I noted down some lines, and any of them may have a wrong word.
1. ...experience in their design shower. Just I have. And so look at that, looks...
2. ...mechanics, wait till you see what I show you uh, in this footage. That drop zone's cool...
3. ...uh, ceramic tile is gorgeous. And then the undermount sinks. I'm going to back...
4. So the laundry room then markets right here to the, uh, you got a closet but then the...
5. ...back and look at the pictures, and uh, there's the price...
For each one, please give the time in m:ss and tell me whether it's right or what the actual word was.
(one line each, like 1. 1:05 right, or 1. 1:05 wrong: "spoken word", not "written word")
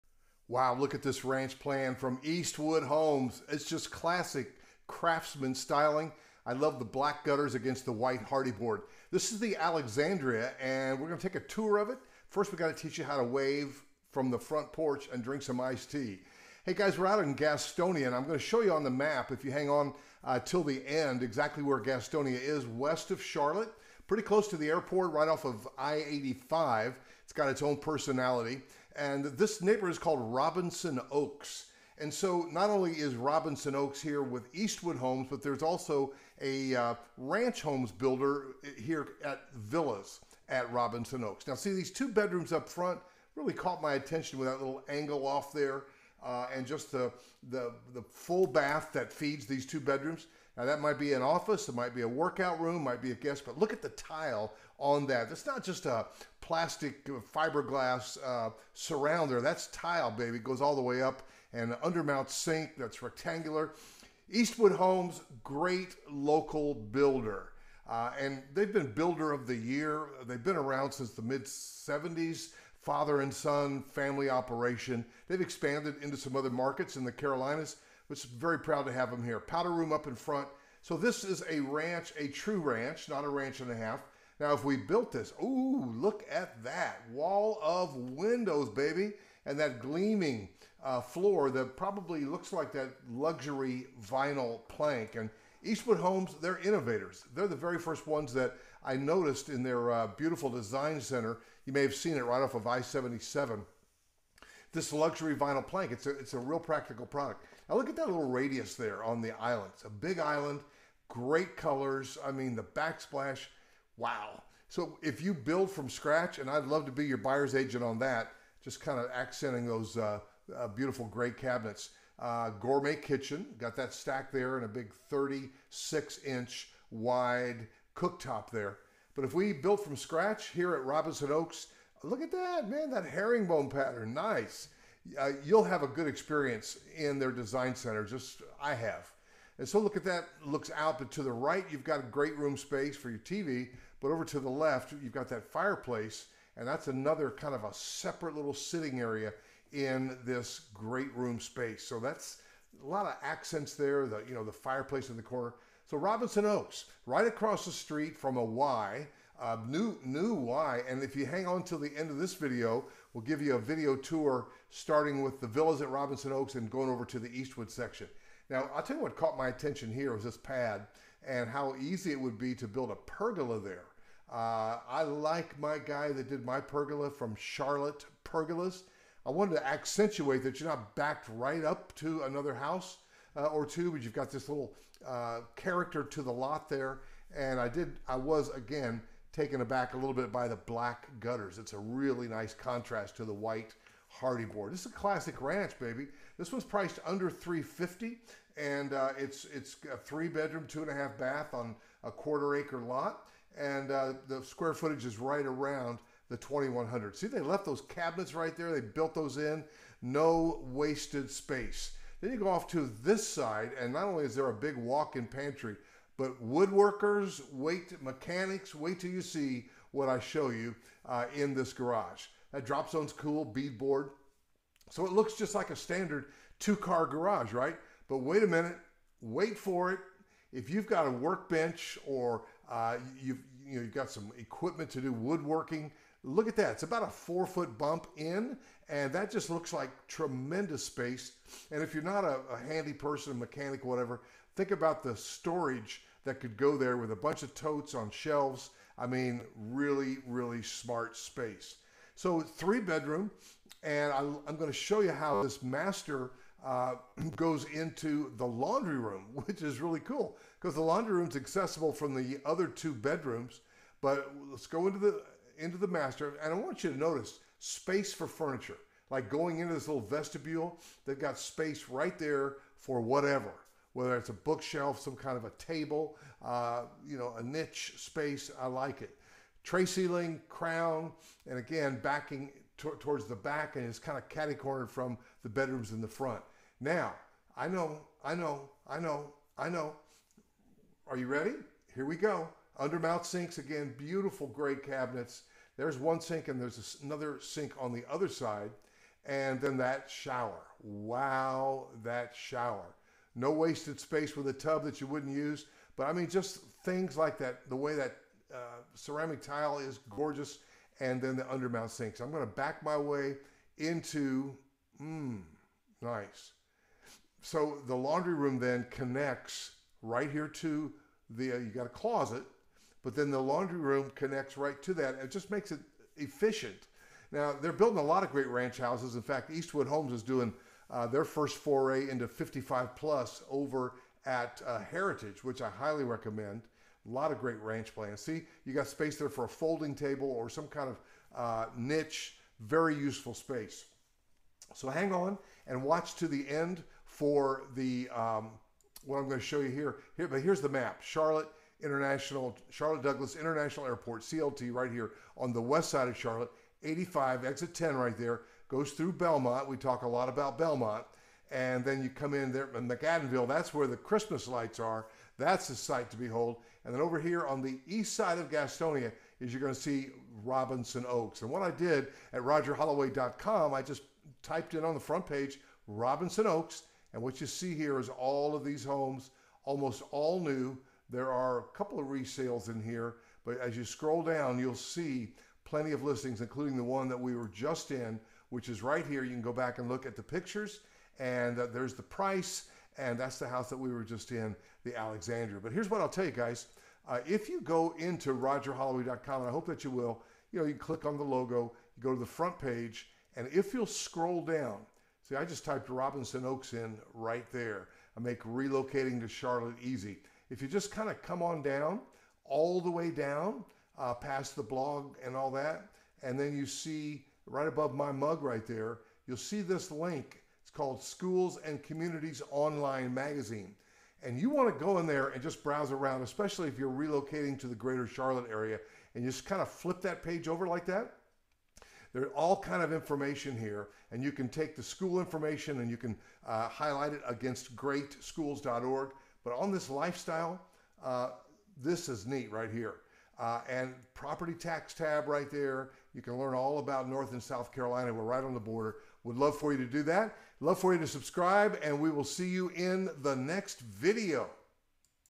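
1. 2:16 wrong: "center", not "shower"
2. 3:37 wrong: "garage", not "footage"
3. 5:08 right
4. 5:17 wrong: "connects", not "markets"
5. 6:29 right.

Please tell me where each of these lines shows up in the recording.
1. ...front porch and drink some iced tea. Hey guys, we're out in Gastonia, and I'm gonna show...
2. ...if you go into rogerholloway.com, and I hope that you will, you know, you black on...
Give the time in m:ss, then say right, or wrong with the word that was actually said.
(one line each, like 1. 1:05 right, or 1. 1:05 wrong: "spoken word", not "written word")
1. 0:14 right
2. 6:37 wrong: "click", not "black".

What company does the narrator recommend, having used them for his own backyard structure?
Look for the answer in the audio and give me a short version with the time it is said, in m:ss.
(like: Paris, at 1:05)
Charlotte Pergolas, at 2:57.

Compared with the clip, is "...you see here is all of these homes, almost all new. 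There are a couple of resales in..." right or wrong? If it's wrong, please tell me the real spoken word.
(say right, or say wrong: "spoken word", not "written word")
right.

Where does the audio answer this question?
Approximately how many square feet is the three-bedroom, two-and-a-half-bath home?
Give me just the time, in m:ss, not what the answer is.
3:26.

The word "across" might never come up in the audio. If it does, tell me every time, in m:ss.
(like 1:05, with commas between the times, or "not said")
2:37.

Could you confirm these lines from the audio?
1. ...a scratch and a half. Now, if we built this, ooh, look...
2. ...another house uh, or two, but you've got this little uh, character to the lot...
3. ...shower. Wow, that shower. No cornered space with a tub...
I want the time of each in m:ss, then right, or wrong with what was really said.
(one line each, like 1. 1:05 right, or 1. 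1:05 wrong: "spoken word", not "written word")
1. 1:23 wrong: "ranch", not "scratch"
2. 3:02 right
3. 5:00 wrong: "wasted", not "cornered".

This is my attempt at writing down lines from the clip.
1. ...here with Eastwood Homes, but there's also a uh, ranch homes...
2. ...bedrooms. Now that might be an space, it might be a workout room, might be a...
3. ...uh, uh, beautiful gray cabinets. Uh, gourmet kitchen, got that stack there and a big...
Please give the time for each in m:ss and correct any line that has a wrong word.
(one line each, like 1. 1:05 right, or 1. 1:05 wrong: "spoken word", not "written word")
1. 0:34 right
2. 0:49 wrong: "office", not "space"
3. 1:59 right.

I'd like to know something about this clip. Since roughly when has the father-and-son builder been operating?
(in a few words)
mid 70s.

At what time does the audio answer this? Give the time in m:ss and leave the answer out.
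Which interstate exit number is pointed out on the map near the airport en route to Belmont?
5:57.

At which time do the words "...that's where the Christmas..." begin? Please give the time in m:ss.
6:03.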